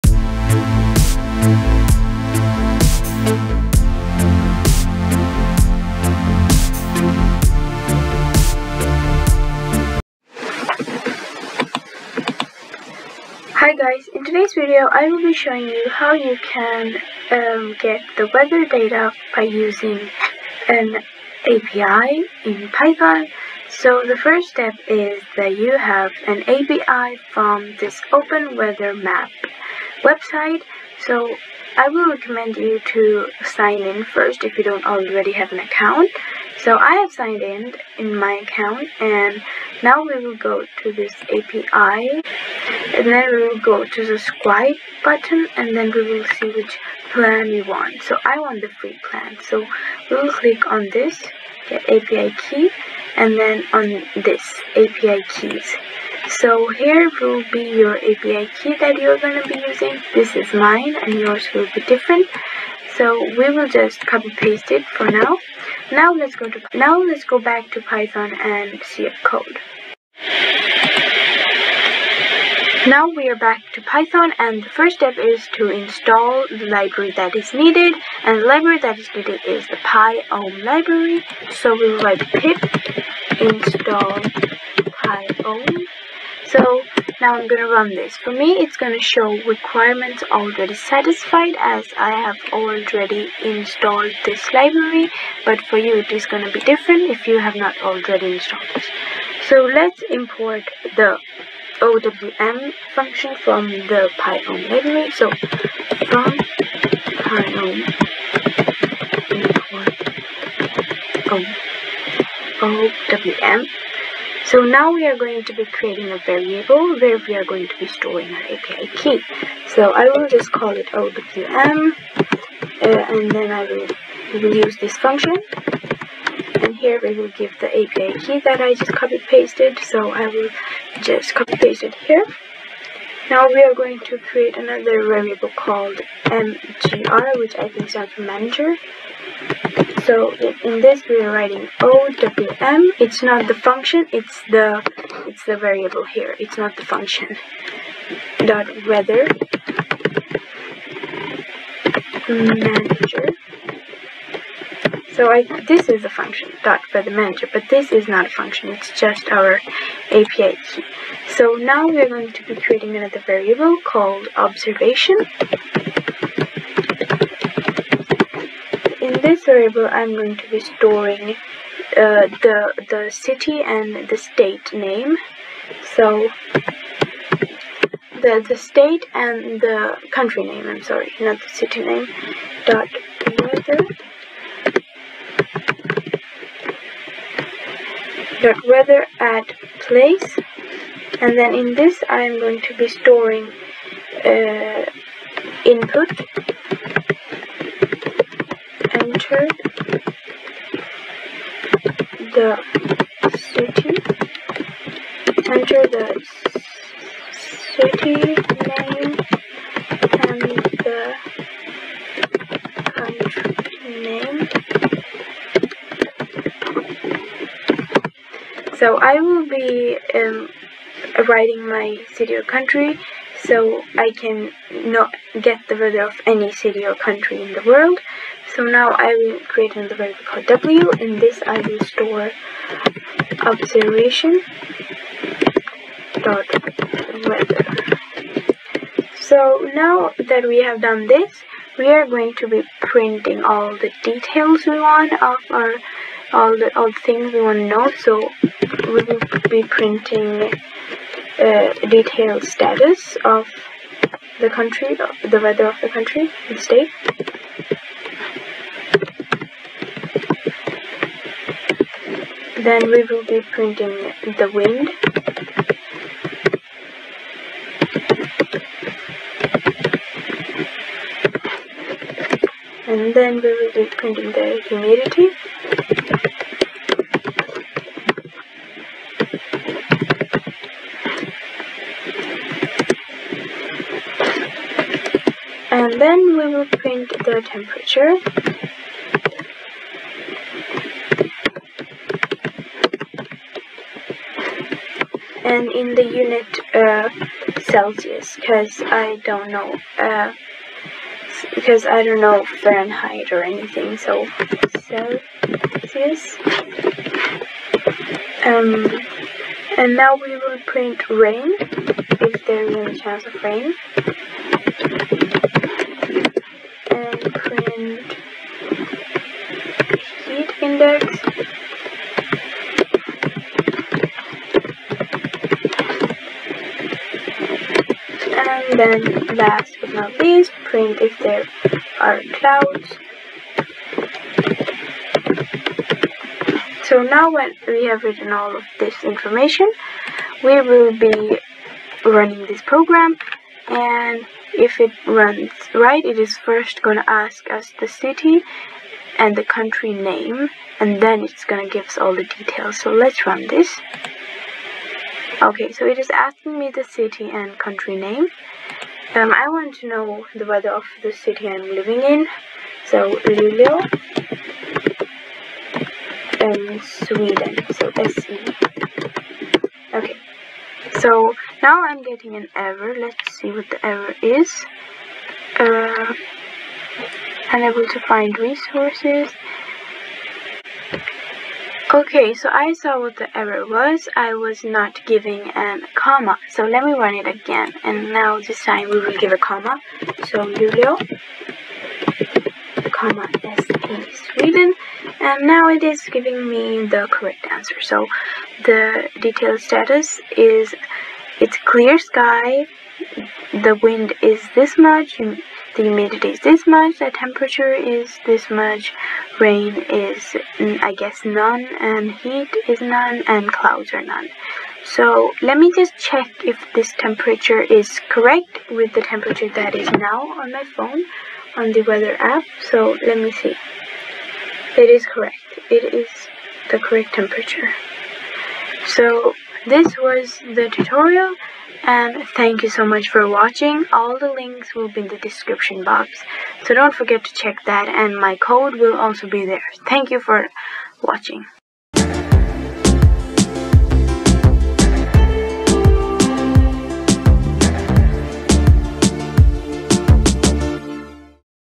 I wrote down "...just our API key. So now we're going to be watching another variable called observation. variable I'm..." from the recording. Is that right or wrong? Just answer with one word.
wrong.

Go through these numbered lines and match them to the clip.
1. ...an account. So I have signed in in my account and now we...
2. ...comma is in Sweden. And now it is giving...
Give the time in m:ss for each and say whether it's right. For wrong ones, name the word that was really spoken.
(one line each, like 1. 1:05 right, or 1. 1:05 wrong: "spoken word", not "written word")
1. 0:35 right
2. 6:32 right.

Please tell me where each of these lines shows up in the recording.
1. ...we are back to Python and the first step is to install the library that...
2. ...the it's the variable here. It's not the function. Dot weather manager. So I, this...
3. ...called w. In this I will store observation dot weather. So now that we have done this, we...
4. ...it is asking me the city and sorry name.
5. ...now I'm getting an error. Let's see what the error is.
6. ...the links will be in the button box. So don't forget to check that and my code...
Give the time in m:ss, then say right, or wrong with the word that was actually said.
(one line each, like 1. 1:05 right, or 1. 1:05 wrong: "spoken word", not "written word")
1. 1:13 right
2. 2:24 right
3. 3:50 right
4. 5:55 wrong: "country", not "sorry"
5. 6:11 right
6. 7:14 wrong: "description", not "button".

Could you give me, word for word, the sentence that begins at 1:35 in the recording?
But for you, it is going to be different if you have not already installed this.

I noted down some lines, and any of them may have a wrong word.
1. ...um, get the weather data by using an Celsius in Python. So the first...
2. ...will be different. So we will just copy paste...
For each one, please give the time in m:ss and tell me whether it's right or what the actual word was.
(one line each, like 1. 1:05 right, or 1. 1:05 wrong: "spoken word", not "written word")
1. 0:17 wrong: "API", not "Celsius"
2. 1:01 right.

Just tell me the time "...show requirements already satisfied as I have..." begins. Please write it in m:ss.
1:28.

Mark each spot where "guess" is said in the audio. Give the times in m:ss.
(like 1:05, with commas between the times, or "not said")
6:50.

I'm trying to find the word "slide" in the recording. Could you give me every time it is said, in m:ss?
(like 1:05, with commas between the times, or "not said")
not said.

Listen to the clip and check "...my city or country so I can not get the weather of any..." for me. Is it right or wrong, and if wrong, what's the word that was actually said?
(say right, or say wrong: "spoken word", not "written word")
right.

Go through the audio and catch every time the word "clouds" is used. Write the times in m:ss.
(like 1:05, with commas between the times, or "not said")
5:32, 6:53.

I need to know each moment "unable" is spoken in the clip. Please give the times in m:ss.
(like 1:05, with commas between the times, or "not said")
6:17.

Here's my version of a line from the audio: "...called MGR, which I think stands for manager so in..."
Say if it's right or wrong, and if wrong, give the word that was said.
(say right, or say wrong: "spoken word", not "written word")
right.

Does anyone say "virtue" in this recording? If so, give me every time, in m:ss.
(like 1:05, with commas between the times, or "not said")
not said.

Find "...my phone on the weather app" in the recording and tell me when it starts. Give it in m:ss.
7:00.